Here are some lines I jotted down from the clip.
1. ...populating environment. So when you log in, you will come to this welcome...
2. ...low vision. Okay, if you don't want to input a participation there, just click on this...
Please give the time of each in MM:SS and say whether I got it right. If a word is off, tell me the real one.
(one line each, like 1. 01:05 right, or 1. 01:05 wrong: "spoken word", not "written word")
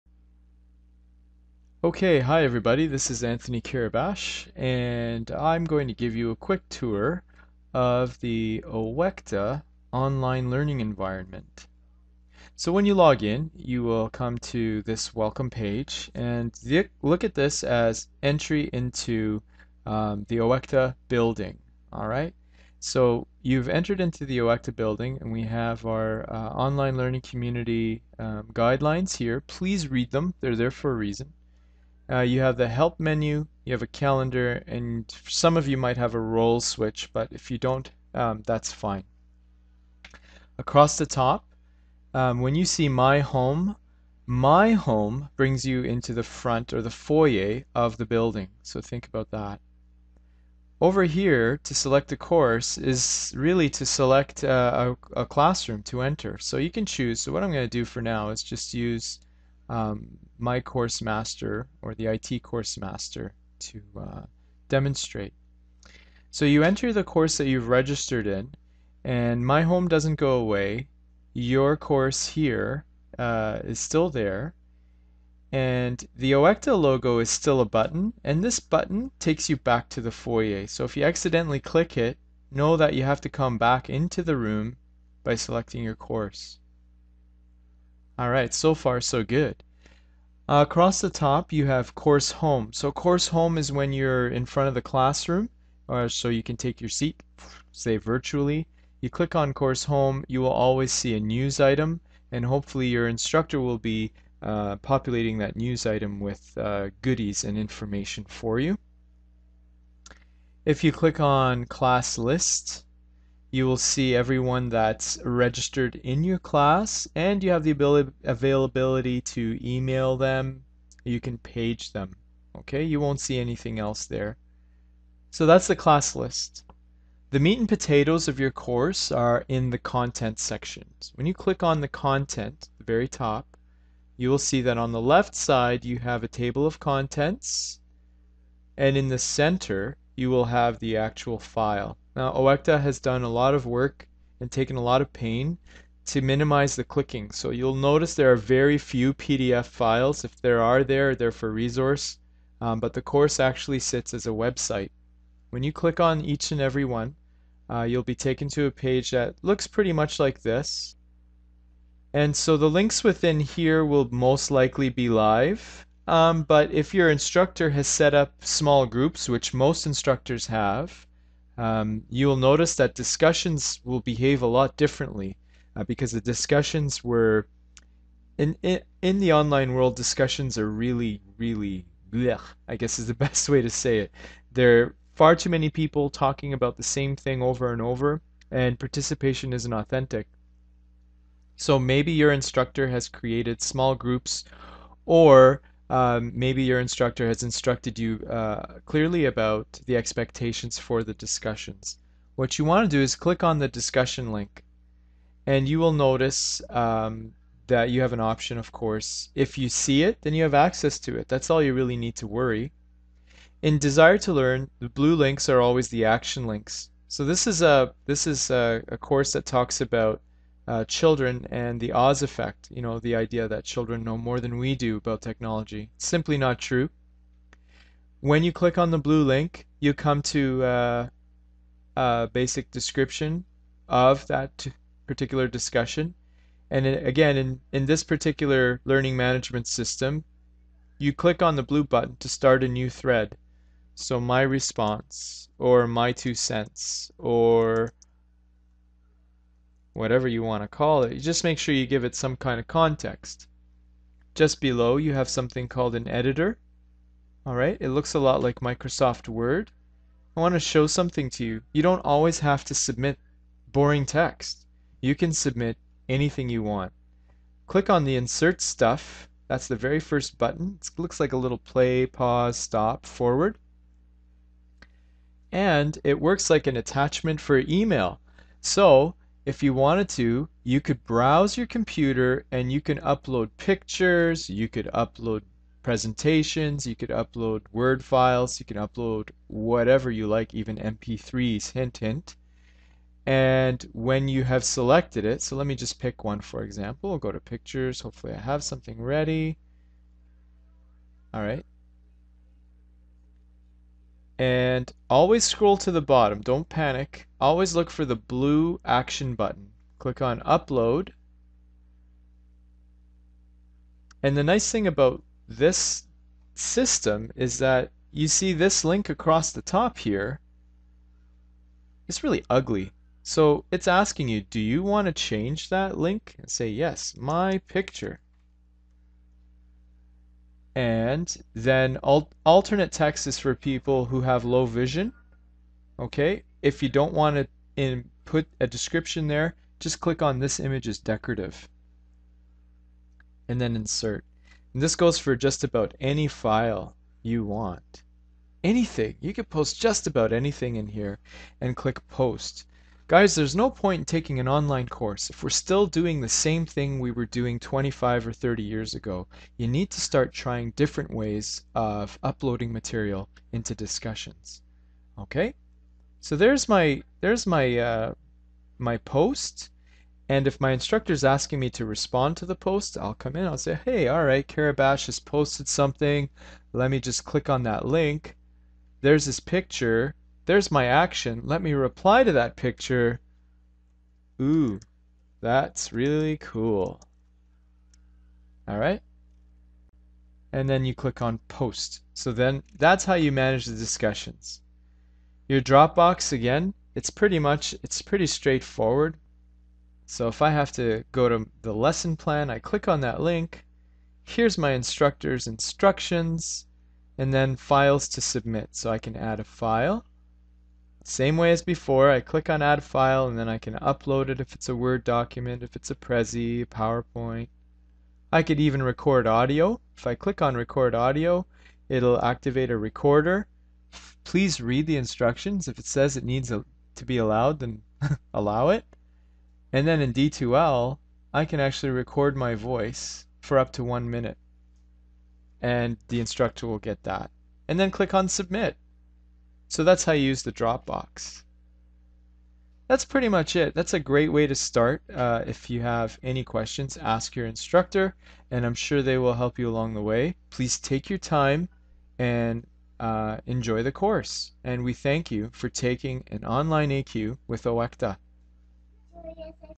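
1. 00:10 wrong: "learning", not "populating"
2. 05:34 wrong: "description", not "participation".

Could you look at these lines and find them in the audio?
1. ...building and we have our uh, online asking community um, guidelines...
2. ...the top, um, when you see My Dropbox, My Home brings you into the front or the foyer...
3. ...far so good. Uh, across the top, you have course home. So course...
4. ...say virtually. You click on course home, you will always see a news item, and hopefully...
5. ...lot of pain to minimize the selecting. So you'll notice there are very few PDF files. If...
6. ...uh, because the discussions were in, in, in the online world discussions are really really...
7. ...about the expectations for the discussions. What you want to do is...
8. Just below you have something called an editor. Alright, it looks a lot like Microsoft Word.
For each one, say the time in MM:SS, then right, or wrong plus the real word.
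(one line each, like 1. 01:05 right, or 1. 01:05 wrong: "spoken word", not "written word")
1. 00:24 wrong: "learning", not "asking"
2. 00:40 wrong: "Home", not "Dropbox"
3. 01:28 right
4. 01:37 right
5. 02:24 wrong: "clicking", not "selecting"
6. 02:55 right
7. 03:19 right
8. 04:14 right.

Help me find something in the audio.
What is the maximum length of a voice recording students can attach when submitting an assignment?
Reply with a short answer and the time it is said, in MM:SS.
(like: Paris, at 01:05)
1 minute, at 07:13.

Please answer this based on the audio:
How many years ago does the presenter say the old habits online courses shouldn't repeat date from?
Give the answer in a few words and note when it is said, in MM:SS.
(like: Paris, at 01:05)
25 or 30 years, at 05:57.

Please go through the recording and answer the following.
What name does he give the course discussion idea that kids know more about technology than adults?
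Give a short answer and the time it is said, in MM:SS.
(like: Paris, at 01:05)
the Oz effect, at 03:41.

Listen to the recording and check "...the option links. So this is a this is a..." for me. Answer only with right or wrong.
wrong.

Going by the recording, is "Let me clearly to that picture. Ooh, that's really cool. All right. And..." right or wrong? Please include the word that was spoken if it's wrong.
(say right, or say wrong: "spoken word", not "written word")
wrong: "reply", not "clearly".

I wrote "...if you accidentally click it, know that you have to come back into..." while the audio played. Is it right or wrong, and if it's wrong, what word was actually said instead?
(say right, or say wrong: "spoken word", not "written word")
right.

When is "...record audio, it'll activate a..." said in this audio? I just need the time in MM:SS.
07:00.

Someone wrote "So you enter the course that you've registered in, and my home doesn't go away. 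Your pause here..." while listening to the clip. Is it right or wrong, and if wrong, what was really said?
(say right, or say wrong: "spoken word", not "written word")
wrong: "course", not "pause".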